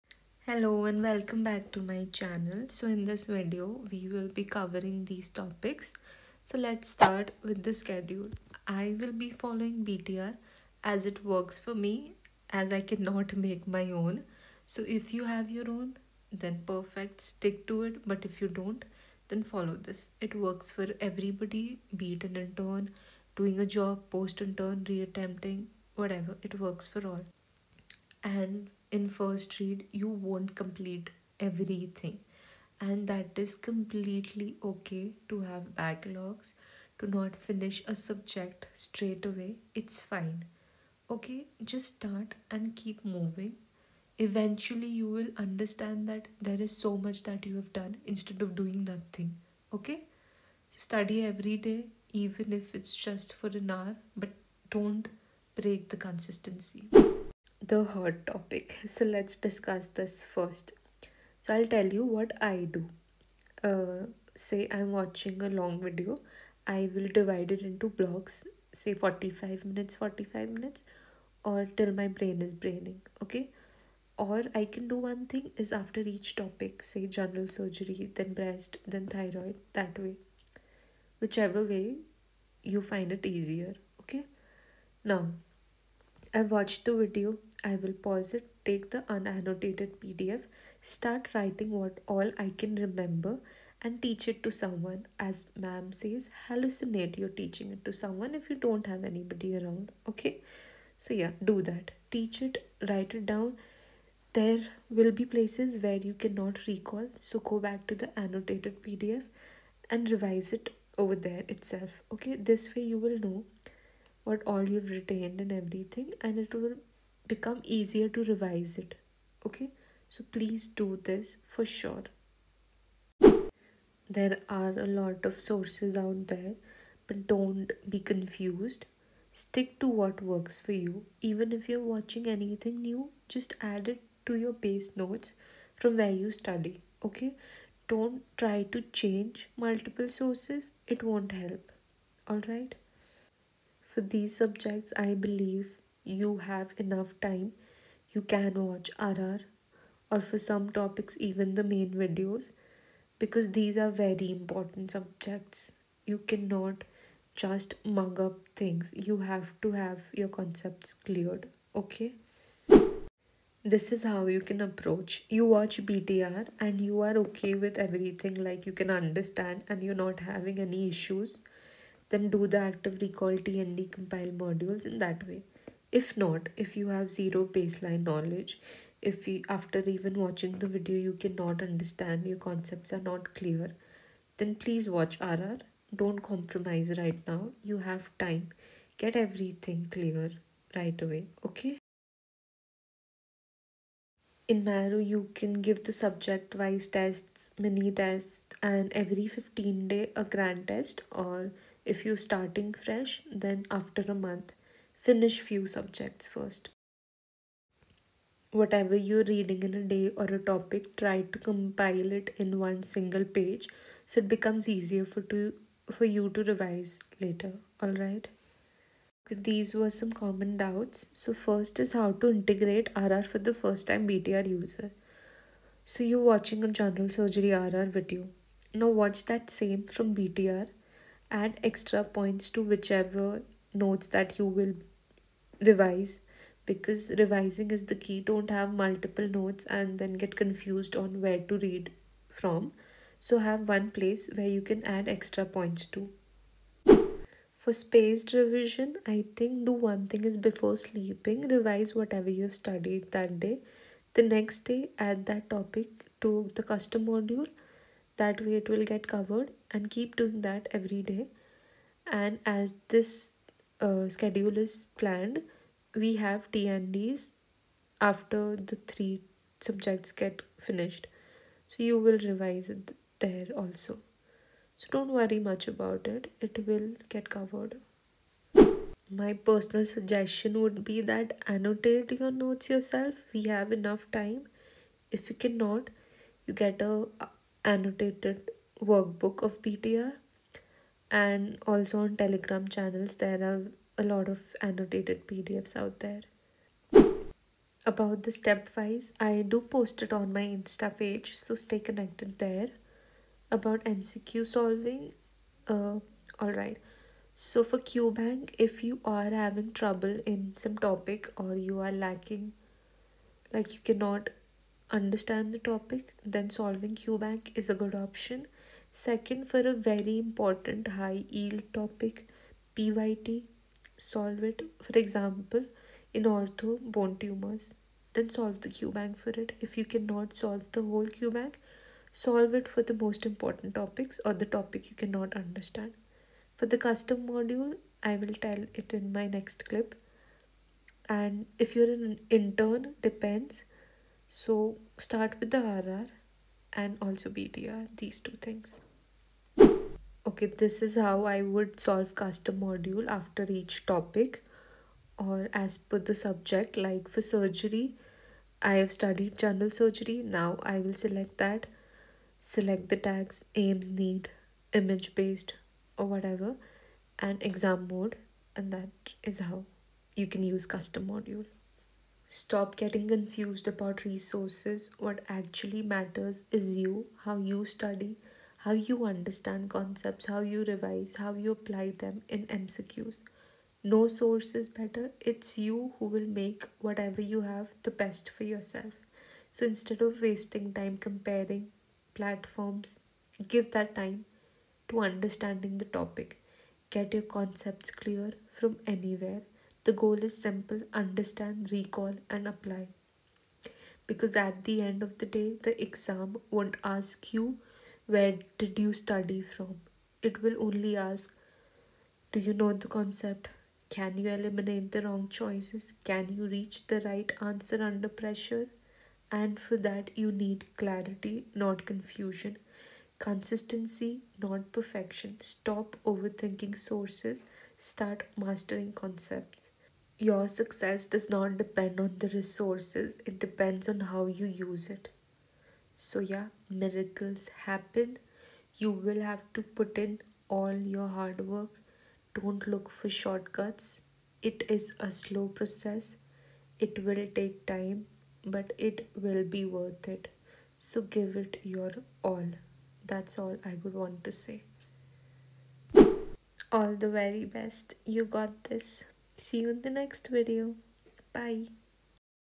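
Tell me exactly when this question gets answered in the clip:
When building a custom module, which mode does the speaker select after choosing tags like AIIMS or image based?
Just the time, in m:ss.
6:07.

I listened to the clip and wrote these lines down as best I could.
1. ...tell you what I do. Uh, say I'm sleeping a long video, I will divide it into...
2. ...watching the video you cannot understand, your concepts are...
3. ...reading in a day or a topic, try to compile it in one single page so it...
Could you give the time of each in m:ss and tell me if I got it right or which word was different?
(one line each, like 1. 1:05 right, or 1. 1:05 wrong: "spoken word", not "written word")
1. 1:01 wrong: "watching", not "sleeping"
2. 3:00 right
3. 3:29 right.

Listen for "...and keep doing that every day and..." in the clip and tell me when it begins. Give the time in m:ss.
4:19.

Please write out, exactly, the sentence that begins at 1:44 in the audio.
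There will be places where you cannot recall, so go back to the annotated PDF and revise it over there itself, okay?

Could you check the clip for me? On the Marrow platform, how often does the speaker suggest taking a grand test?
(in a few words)
Every 15 days.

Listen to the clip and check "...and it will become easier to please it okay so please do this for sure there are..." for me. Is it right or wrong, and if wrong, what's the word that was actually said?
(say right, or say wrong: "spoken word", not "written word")
wrong: "revise", not "please".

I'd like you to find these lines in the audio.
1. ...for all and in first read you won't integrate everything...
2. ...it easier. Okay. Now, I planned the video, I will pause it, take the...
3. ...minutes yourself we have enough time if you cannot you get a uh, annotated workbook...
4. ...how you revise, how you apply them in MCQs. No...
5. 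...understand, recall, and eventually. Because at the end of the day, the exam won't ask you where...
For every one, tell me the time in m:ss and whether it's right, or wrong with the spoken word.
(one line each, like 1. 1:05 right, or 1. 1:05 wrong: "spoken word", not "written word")
1. 0:26 wrong: "complete", not "integrate"
2. 1:23 wrong: "watched", not "planned"
3. 4:42 wrong: "notes", not "minutes"
4. 6:20 right
5. 6:40 wrong: "apply", not "eventually".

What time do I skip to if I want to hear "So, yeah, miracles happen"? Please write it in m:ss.
7:15.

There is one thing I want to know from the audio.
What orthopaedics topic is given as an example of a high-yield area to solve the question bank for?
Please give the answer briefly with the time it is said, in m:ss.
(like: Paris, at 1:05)
Bone tumors, at 5:26.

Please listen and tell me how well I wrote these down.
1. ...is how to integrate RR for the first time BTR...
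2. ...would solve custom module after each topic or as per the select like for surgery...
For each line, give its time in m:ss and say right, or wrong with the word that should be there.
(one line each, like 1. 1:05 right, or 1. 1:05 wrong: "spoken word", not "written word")
1. 3:41 right
2. 5:51 wrong: "subject", not "select".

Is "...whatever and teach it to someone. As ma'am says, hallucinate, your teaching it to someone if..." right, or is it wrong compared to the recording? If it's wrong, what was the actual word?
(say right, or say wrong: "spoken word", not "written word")
wrong: "remember", not "whatever".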